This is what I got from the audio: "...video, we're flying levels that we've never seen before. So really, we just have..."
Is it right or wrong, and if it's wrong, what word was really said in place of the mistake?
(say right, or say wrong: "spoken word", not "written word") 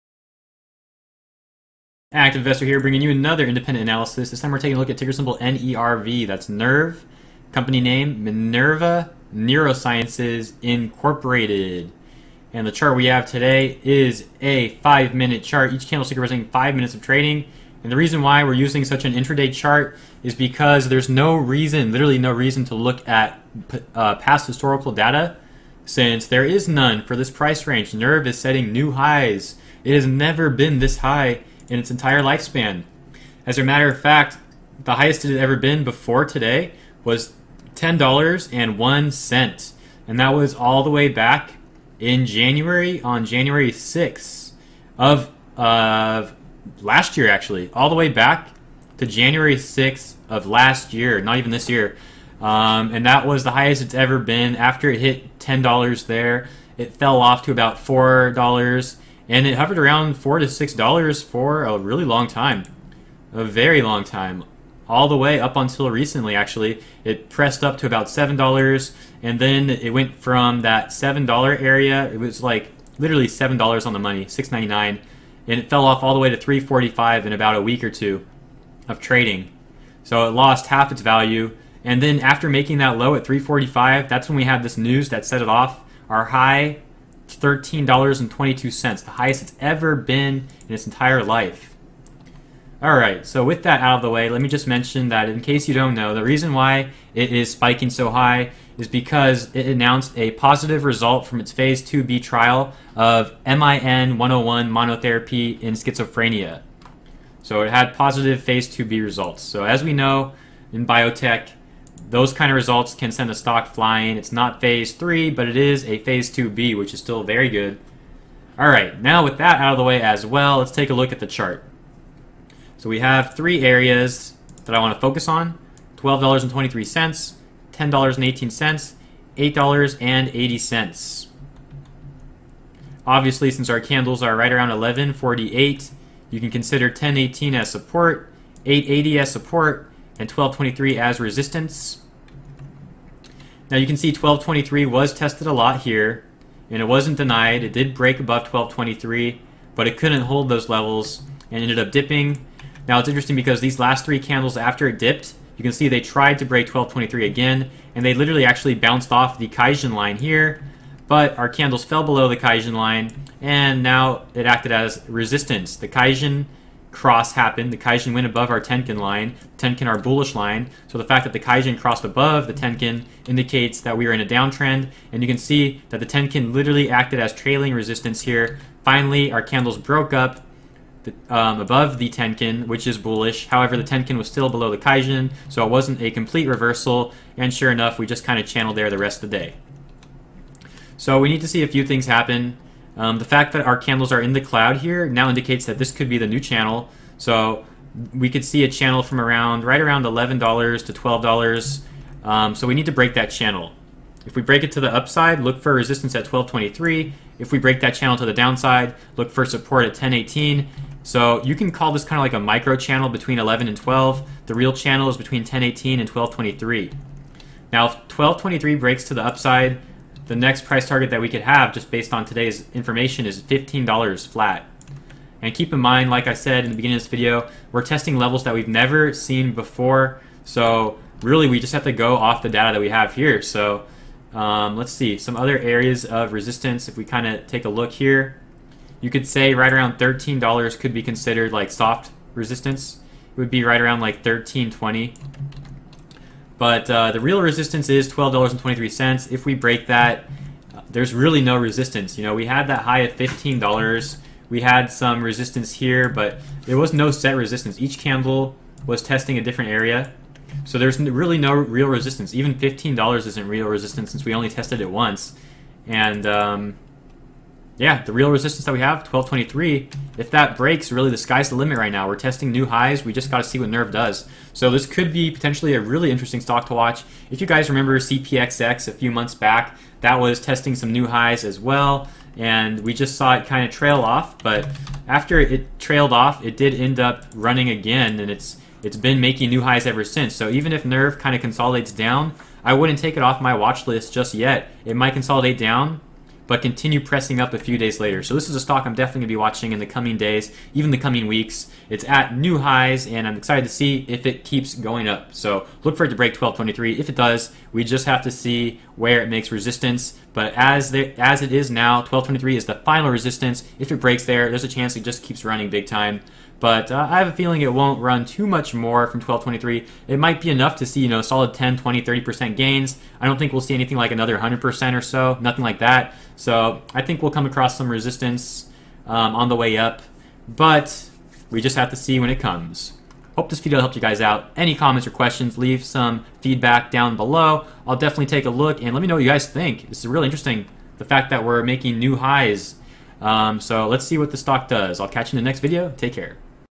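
wrong: "testing", not "flying".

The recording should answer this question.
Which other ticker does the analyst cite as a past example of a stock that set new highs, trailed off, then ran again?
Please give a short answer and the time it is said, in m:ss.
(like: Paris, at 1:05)
CPXX, at 4:37.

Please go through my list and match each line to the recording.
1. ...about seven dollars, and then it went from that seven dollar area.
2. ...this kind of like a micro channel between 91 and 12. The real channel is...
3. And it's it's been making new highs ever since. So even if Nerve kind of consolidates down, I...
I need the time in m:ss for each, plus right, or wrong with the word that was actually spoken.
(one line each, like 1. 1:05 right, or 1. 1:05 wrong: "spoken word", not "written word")
1. 1:07 right
2. 3:31 wrong: "11", not "91"
3. 4:48 right.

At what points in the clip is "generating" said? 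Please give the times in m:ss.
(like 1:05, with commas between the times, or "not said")
not said.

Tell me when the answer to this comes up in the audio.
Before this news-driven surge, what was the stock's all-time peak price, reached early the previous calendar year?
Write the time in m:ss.
0:37.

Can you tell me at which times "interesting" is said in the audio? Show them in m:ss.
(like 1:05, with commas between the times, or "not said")
2:33, 4:36, 5:40.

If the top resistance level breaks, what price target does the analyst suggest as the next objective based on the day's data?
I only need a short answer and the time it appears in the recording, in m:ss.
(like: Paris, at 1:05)
$15, at 3:43.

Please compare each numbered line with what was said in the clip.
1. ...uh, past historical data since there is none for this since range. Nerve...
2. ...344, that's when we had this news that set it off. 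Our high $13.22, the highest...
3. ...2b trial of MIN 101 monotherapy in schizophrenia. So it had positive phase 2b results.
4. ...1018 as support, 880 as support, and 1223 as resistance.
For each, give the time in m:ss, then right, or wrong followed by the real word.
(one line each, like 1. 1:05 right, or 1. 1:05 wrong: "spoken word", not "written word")
1. 0:23 wrong: "price", not "since"
2. 1:23 wrong: "345", not "344"
3. 1:41 right
4. 2:16 right.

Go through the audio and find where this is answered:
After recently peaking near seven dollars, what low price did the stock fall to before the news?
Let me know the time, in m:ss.
1:16.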